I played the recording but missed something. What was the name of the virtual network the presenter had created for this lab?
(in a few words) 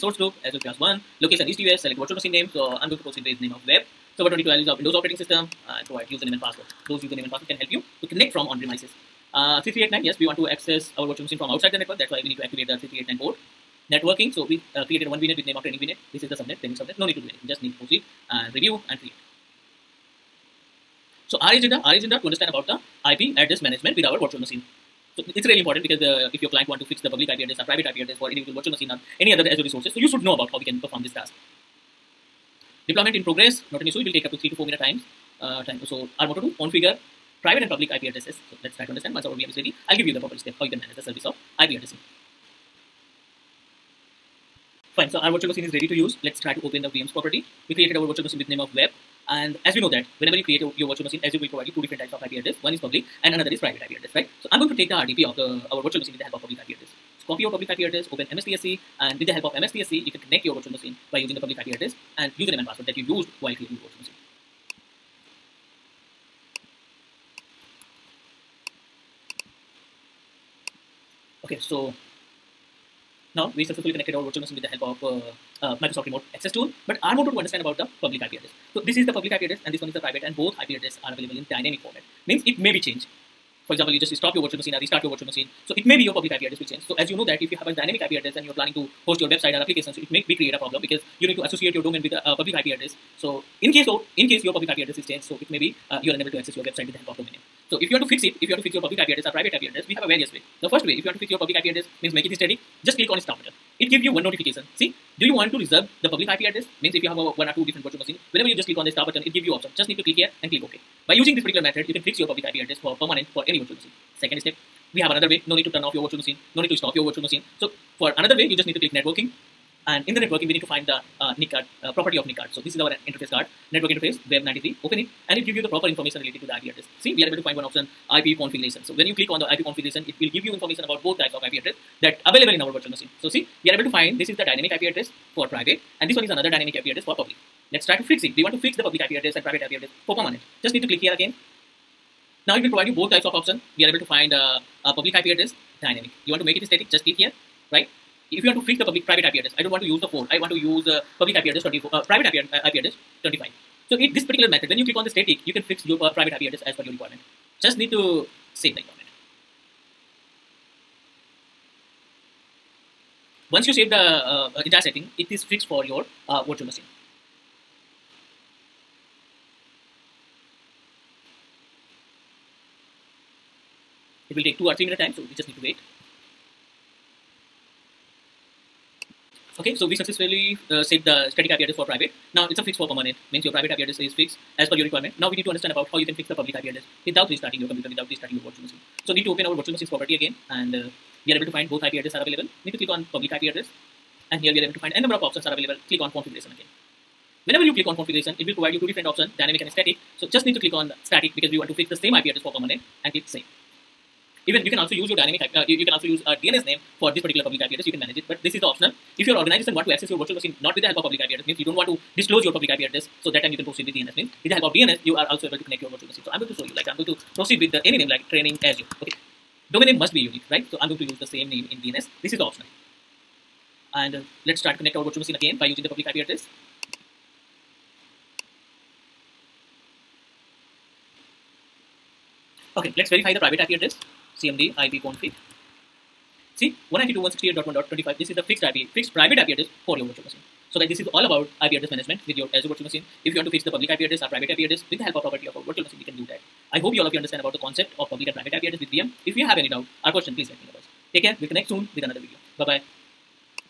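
training VNet.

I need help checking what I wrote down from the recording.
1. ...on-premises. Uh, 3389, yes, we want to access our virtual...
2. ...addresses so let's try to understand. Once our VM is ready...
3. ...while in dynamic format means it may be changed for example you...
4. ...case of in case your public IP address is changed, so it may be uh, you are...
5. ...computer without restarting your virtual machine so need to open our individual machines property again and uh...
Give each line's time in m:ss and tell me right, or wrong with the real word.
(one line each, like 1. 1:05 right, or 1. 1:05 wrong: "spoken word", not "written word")
1. 0:08 right
2. 0:38 right
3. 1:21 wrong: "available", not "while"
4. 1:33 right
5. 3:07 wrong: "virtual", not "individual".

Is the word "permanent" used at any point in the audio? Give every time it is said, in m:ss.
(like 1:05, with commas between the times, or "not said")
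1:53, 2:20, 3:02, 3:22.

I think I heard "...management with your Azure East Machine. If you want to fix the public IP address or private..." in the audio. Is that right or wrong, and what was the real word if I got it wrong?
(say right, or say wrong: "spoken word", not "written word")
wrong: "Virtual", not "East".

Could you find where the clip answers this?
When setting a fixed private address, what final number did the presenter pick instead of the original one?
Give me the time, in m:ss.
2:33.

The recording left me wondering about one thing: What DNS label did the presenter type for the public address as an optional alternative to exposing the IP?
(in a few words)
training Azure.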